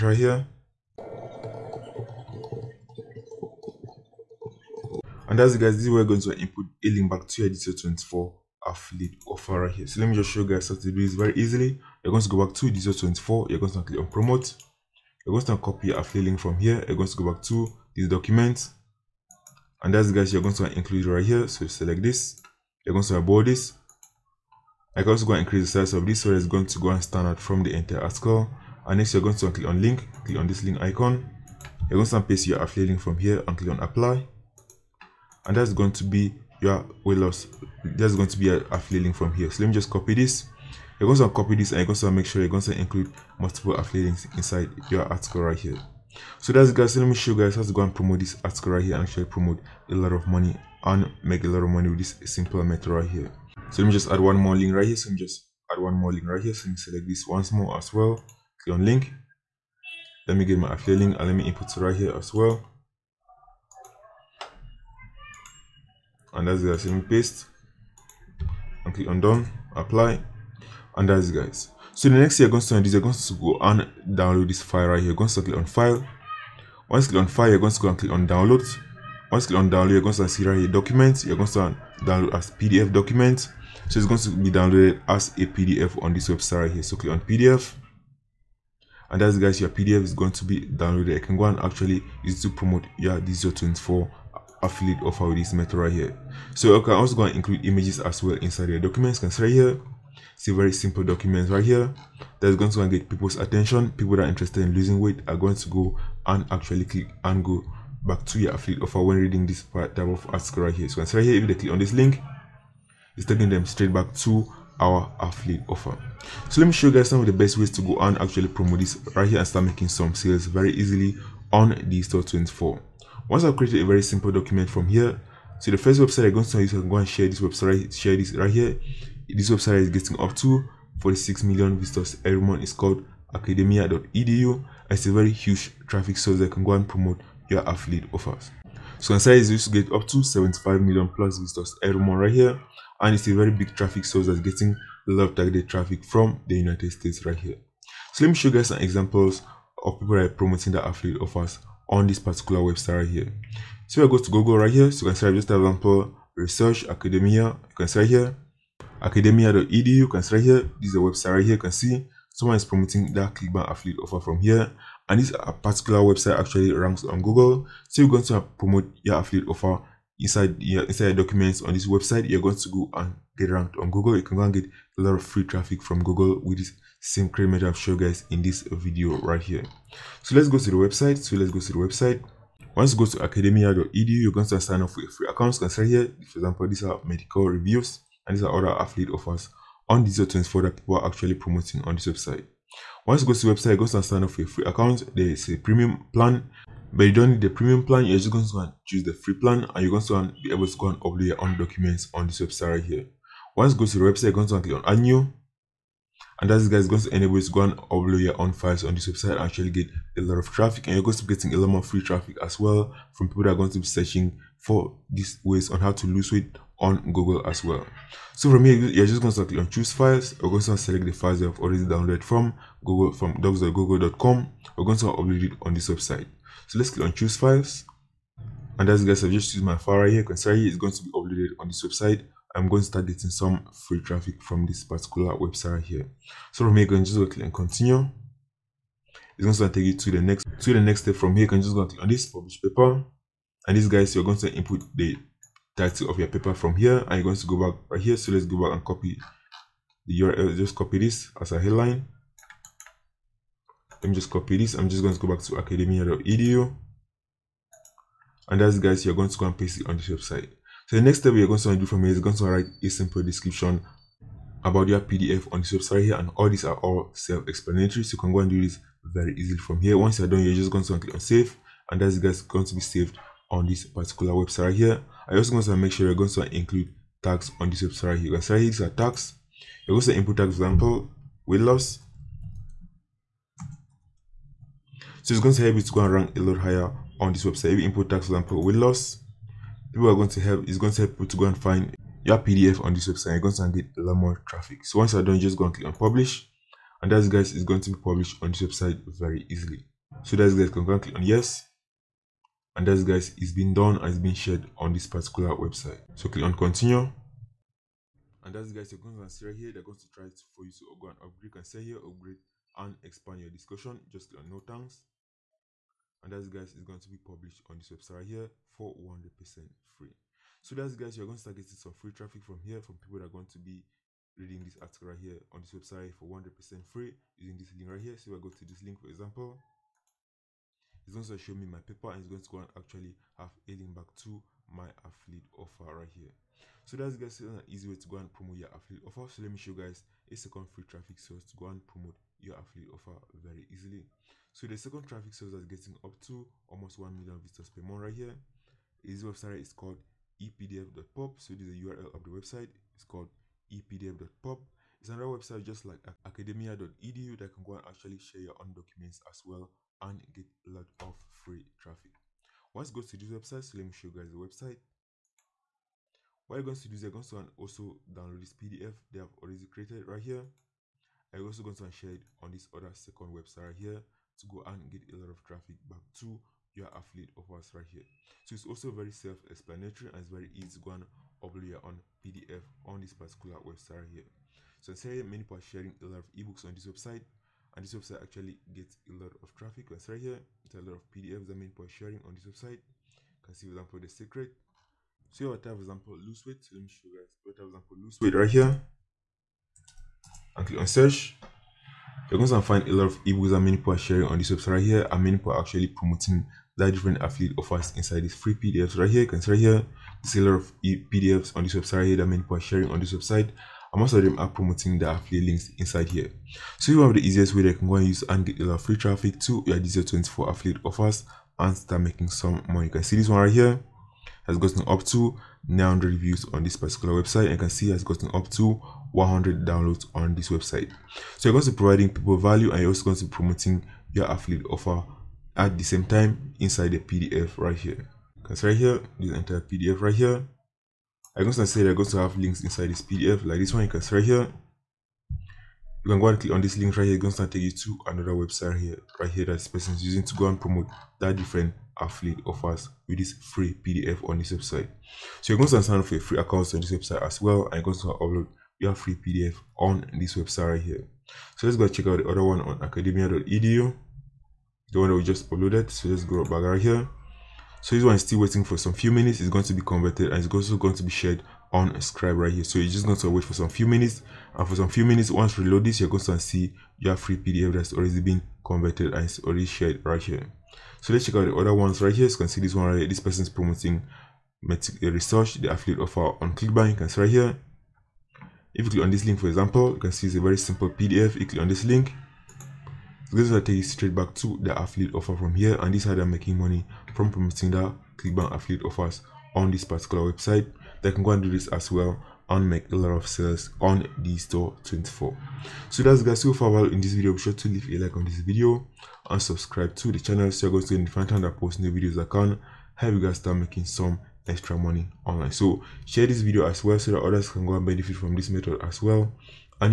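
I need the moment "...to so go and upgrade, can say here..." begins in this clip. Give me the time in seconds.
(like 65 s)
310 s.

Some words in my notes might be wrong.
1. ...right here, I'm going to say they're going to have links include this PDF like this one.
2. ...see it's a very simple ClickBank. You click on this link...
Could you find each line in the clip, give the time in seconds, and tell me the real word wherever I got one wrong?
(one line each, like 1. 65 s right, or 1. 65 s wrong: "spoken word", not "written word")
1. 439 s wrong: "inside", not "include"
2. 490 s wrong: "PDF", not "ClickBank".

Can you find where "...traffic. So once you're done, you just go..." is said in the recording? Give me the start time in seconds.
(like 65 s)
294 s.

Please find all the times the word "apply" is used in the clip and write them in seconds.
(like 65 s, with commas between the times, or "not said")
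33 s, 69 s.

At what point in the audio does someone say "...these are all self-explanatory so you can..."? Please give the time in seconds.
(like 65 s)
266 s.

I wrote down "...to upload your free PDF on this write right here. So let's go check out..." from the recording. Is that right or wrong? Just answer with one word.
wrong.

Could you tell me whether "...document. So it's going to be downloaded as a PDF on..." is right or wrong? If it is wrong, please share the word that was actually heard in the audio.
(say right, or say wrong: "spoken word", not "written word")
right.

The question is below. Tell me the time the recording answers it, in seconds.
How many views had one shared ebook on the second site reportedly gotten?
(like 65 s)
425 s.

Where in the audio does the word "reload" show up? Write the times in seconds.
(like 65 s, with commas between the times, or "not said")
475 s.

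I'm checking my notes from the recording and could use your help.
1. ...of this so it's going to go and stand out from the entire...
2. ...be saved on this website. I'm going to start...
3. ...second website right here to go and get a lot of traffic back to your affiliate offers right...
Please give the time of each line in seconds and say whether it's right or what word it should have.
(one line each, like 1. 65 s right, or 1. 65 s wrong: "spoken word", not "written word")
1. 25 s right
2. 231 s wrong: "uploaded", not "saved"
3. 372 s right.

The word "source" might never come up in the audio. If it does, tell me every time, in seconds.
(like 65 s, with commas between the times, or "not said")
136 s, 144 s, 341 s, 345 s.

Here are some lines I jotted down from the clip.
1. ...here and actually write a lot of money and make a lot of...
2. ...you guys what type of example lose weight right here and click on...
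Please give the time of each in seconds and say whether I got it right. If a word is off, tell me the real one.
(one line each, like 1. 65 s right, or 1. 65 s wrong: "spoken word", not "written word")
1. 48 s wrong: "promote", not "write"
2. 397 s right.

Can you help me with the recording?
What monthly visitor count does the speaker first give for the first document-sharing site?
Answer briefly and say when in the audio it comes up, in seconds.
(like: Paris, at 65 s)
46 million, at 130 s.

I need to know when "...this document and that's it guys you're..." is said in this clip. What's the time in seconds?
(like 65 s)
17 s.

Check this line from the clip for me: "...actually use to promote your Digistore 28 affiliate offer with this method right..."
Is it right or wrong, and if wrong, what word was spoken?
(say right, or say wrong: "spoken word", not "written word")
wrong: "24", not "28".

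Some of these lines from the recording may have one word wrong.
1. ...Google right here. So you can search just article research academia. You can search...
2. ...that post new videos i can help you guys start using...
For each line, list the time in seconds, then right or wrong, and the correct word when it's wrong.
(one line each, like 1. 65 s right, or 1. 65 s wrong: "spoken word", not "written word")
1. 154 s wrong: "example", not "article"
2. 511 s wrong: "making", not "using".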